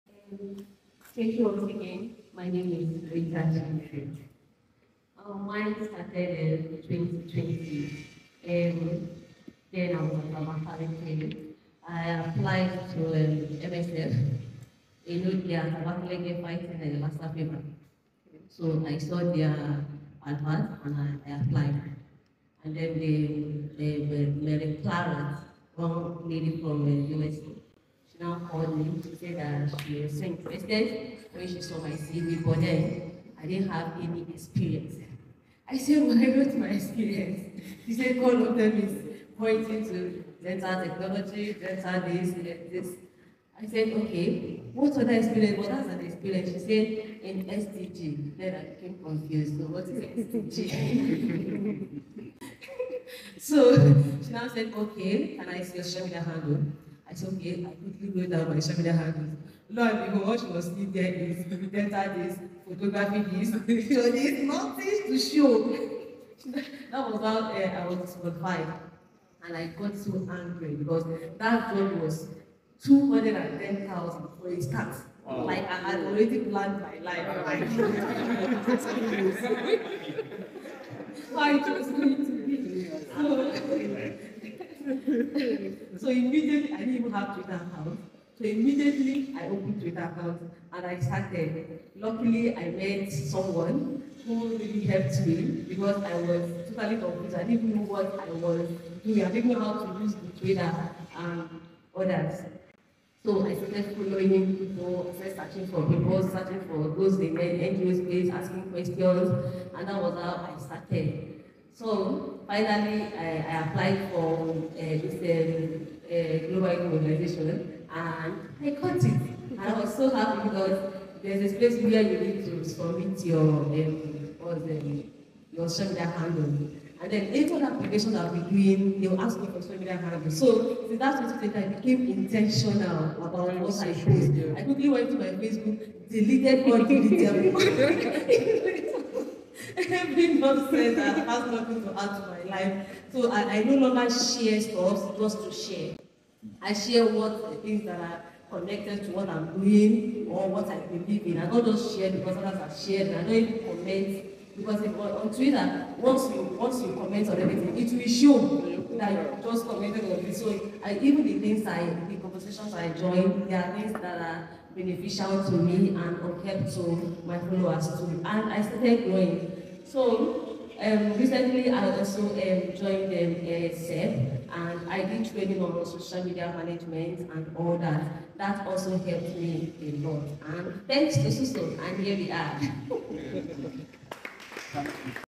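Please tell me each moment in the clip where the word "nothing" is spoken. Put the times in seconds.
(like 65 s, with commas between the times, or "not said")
64 s, 141 s.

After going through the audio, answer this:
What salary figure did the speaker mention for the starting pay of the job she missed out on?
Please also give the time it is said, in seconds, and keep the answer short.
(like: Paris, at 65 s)
210,000, at 72 s.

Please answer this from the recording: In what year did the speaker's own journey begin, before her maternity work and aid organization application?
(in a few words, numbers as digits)
2020.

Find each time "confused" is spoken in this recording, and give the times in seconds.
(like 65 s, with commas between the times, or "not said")
49 s, 97 s.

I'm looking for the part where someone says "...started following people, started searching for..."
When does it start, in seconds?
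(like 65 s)
103 s.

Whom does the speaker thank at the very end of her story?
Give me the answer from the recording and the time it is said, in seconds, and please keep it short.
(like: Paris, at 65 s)
Susan, at 181 s.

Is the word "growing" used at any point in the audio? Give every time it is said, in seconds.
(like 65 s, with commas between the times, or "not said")
169 s.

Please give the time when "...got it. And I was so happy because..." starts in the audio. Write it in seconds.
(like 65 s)
118 s.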